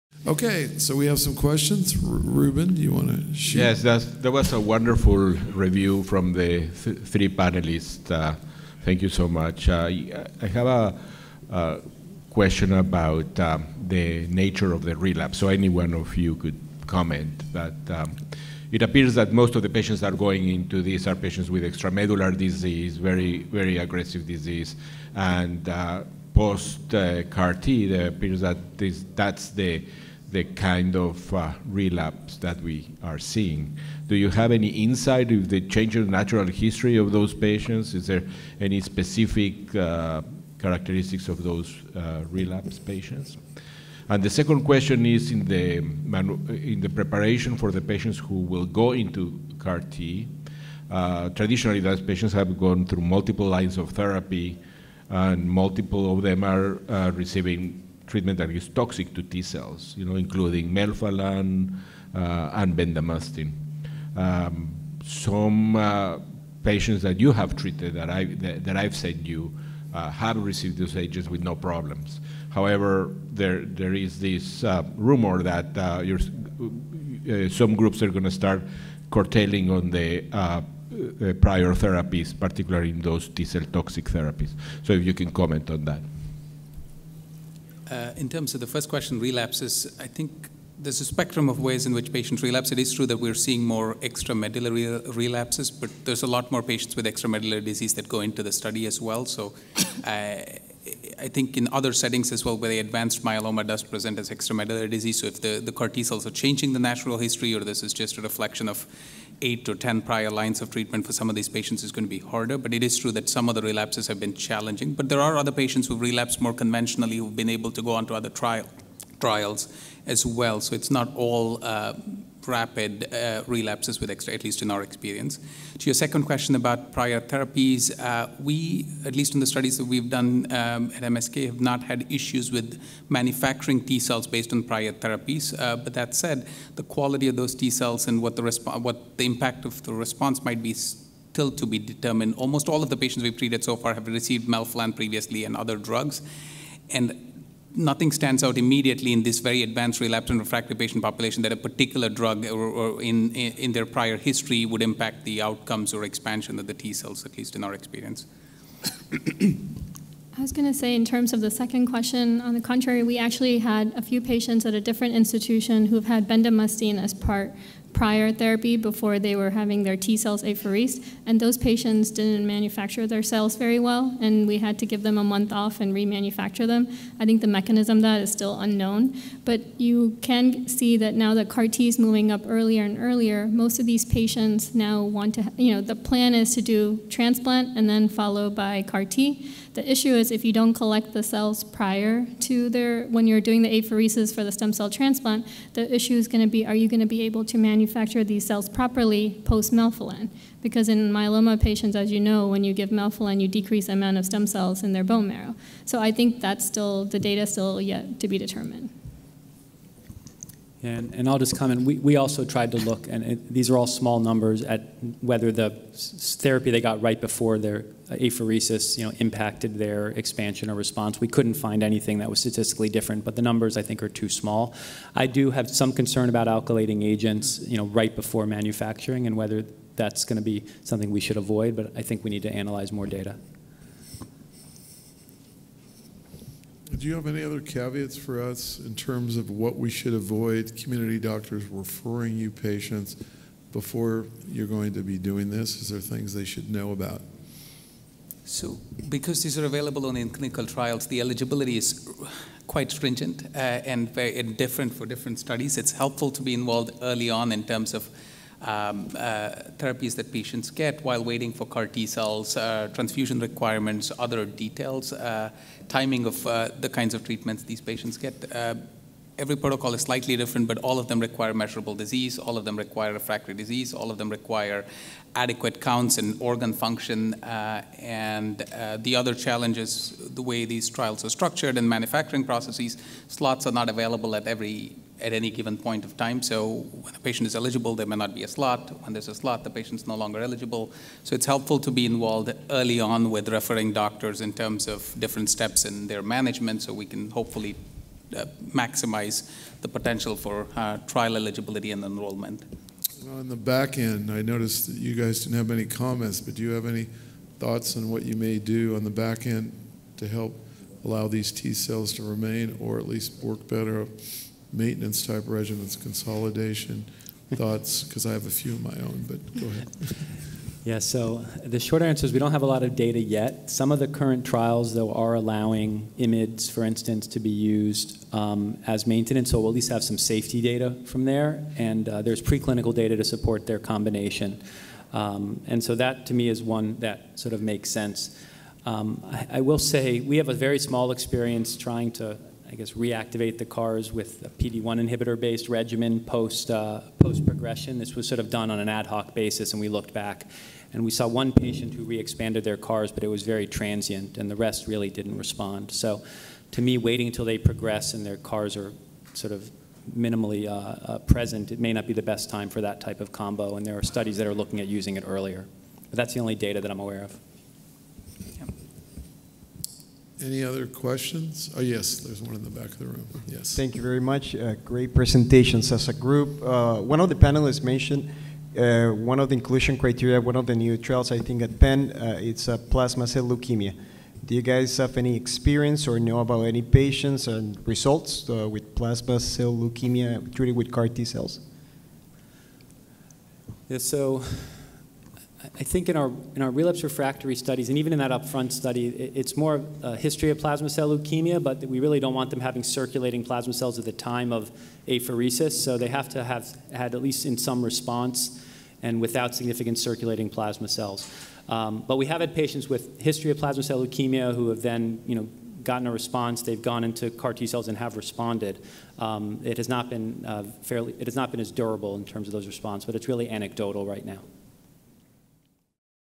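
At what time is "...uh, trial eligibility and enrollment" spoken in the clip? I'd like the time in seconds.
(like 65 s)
300 s.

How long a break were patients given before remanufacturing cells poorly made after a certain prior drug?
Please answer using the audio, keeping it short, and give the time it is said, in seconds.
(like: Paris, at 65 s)
A month, at 175 s.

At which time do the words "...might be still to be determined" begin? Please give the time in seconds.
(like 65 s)
140 s.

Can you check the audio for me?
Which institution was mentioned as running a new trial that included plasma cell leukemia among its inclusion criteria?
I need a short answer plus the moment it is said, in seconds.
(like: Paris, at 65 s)
Penn, at 381 s.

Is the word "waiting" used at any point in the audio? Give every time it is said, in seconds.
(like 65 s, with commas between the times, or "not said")
261 s, 356 s.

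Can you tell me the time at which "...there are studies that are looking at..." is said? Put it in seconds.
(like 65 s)
363 s.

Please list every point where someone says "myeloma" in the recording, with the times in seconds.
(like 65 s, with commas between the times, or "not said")
103 s, 201 s.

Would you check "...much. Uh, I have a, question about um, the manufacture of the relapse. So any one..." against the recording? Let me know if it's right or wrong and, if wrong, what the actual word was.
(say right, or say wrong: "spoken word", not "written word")
wrong: "nature", not "manufacture".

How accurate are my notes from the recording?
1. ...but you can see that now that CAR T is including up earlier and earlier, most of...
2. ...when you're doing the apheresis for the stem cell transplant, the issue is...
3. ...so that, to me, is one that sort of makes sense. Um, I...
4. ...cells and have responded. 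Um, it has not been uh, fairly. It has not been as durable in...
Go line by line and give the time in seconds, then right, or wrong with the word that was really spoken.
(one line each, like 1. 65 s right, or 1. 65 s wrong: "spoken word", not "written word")
1. 179 s wrong: "moving", not "including"
2. 193 s right
3. 335 s right
4. 417 s right.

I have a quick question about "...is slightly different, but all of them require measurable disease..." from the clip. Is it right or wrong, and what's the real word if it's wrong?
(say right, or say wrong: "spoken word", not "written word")
right.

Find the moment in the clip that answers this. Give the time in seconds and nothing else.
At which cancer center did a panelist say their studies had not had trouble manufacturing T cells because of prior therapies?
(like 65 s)
131 s.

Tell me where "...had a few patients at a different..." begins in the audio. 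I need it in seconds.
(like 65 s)
163 s.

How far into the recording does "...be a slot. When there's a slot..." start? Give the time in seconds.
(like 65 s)
288 s.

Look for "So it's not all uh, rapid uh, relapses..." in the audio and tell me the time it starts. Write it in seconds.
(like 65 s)
120 s.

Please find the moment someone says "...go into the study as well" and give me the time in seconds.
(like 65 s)
98 s.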